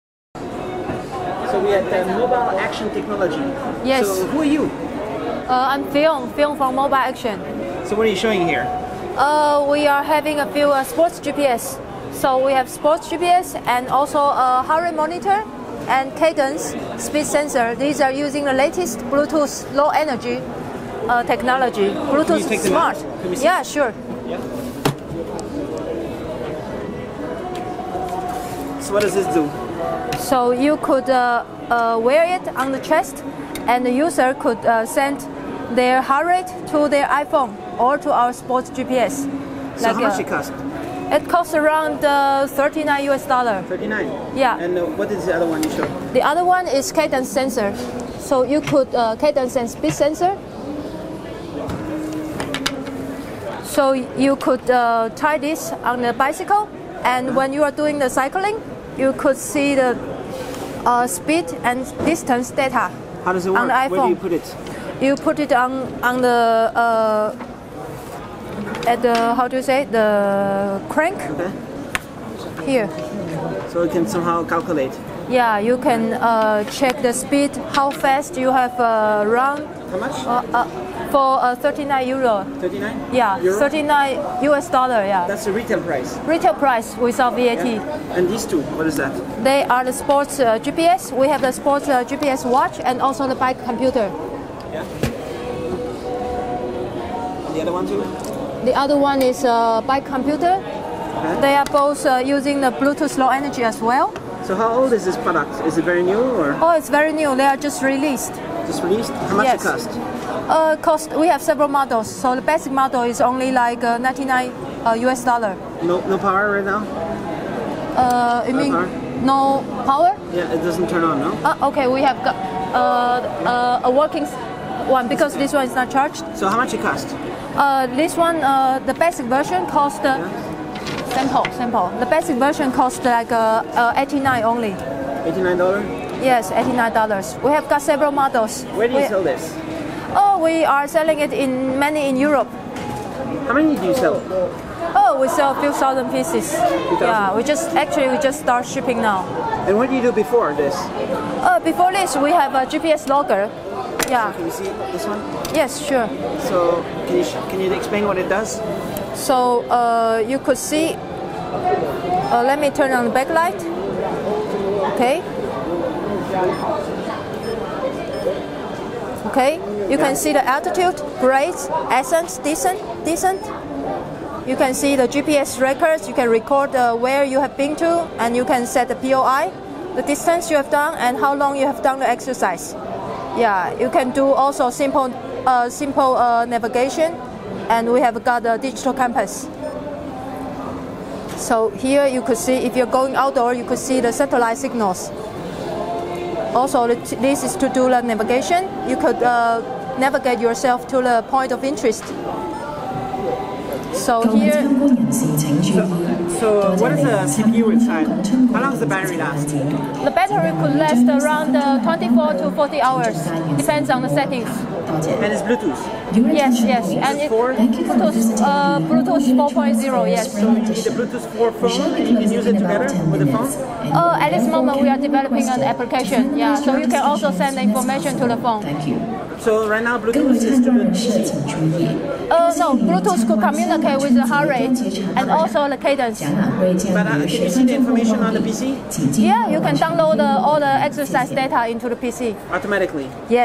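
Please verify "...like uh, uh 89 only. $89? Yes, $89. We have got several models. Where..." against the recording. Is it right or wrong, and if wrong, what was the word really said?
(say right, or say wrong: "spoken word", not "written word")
right.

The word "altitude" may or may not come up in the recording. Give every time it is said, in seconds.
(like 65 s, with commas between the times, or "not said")
170 s.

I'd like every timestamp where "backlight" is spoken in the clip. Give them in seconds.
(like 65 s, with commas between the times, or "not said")
163 s.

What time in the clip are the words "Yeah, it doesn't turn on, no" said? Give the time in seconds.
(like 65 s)
120 s.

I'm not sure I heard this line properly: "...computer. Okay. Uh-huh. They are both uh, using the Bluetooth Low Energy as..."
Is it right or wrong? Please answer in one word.
right.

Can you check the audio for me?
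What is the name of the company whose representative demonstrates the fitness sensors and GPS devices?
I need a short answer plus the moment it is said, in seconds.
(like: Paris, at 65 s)
Mobile Action Technology, at 2 s.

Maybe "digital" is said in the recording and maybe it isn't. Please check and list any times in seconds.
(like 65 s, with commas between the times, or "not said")
188 s.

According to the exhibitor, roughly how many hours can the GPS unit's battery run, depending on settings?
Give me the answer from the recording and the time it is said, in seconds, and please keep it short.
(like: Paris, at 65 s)
24 to 40 hours, at 211 s.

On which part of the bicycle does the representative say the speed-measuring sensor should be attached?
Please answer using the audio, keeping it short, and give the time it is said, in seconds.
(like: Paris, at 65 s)
The crank, at 70 s.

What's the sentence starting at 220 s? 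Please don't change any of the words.
So you need a Bluetooth 4 phone and you can use it together with the phone?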